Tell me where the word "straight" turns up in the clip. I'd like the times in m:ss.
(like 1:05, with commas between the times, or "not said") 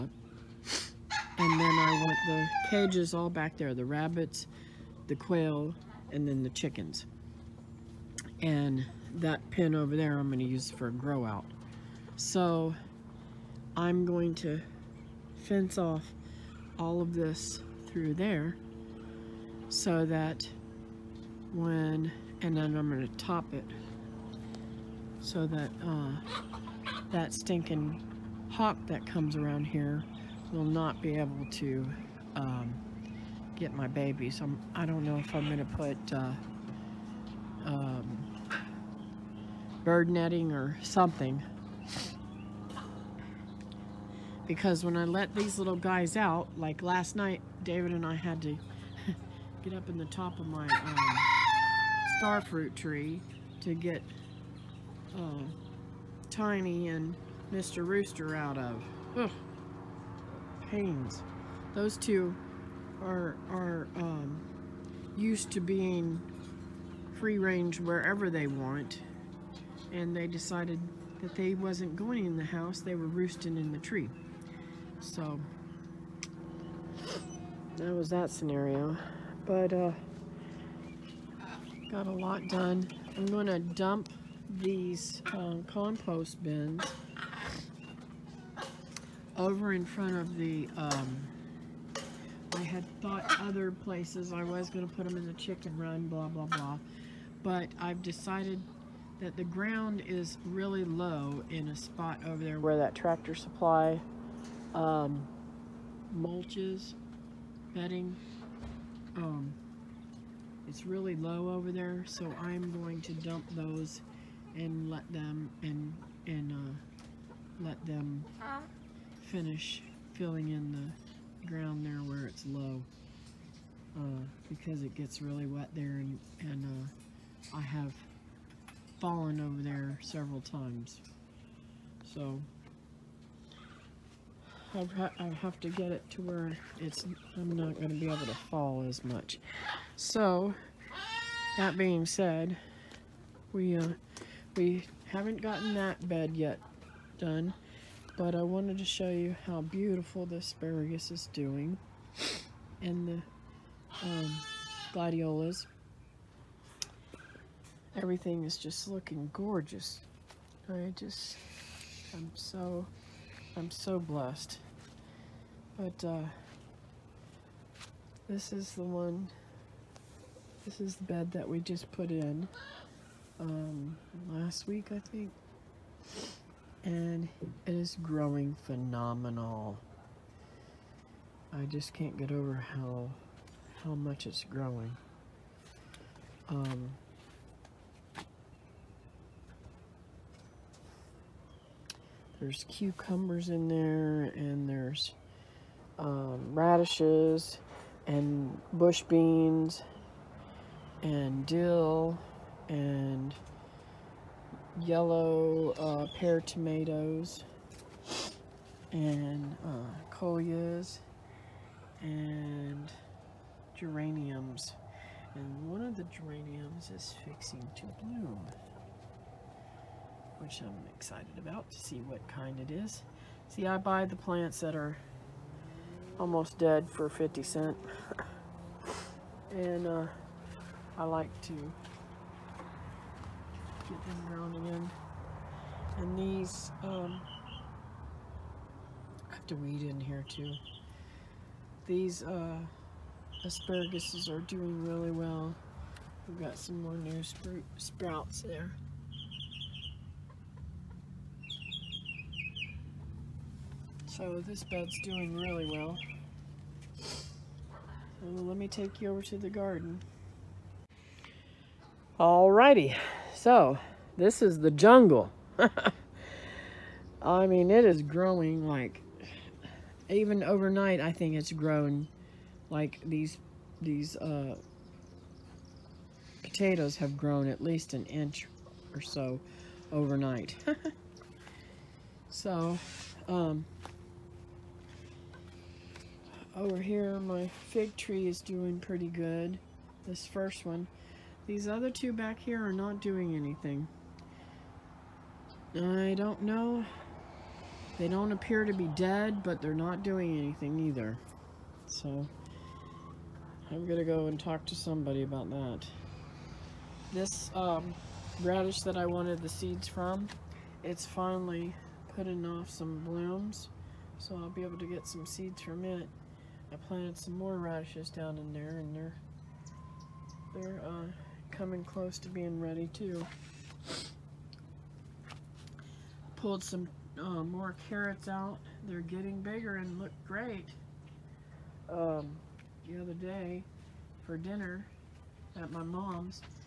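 not said.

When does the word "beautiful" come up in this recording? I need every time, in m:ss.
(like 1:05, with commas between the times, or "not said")
2:29.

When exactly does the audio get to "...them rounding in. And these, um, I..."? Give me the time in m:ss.
3:54.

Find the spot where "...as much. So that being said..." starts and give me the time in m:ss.
2:18.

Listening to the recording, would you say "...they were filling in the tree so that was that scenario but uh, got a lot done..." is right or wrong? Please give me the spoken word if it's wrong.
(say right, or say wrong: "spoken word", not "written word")
wrong: "roosting", not "filling".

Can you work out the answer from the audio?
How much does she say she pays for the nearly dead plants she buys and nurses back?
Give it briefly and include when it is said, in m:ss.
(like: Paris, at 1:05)
50 cents, at 3:47.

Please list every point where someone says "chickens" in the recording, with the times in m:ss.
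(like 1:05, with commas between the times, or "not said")
0:06, 1:35.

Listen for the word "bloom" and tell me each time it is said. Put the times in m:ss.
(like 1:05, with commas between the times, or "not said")
3:38, 5:12.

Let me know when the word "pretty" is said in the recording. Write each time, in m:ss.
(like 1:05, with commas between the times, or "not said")
4:48.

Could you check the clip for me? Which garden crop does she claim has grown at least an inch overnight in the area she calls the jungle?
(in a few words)
potatoes.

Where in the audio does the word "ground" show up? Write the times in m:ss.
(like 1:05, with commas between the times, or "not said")
1:39, 2:01.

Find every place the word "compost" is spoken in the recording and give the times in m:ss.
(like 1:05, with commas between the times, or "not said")
1:25.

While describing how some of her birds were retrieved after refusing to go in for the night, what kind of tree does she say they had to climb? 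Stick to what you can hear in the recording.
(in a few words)
starfruit tree.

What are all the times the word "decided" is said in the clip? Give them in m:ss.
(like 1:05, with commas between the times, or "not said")
1:10, 1:38.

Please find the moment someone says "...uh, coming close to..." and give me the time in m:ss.
5:20.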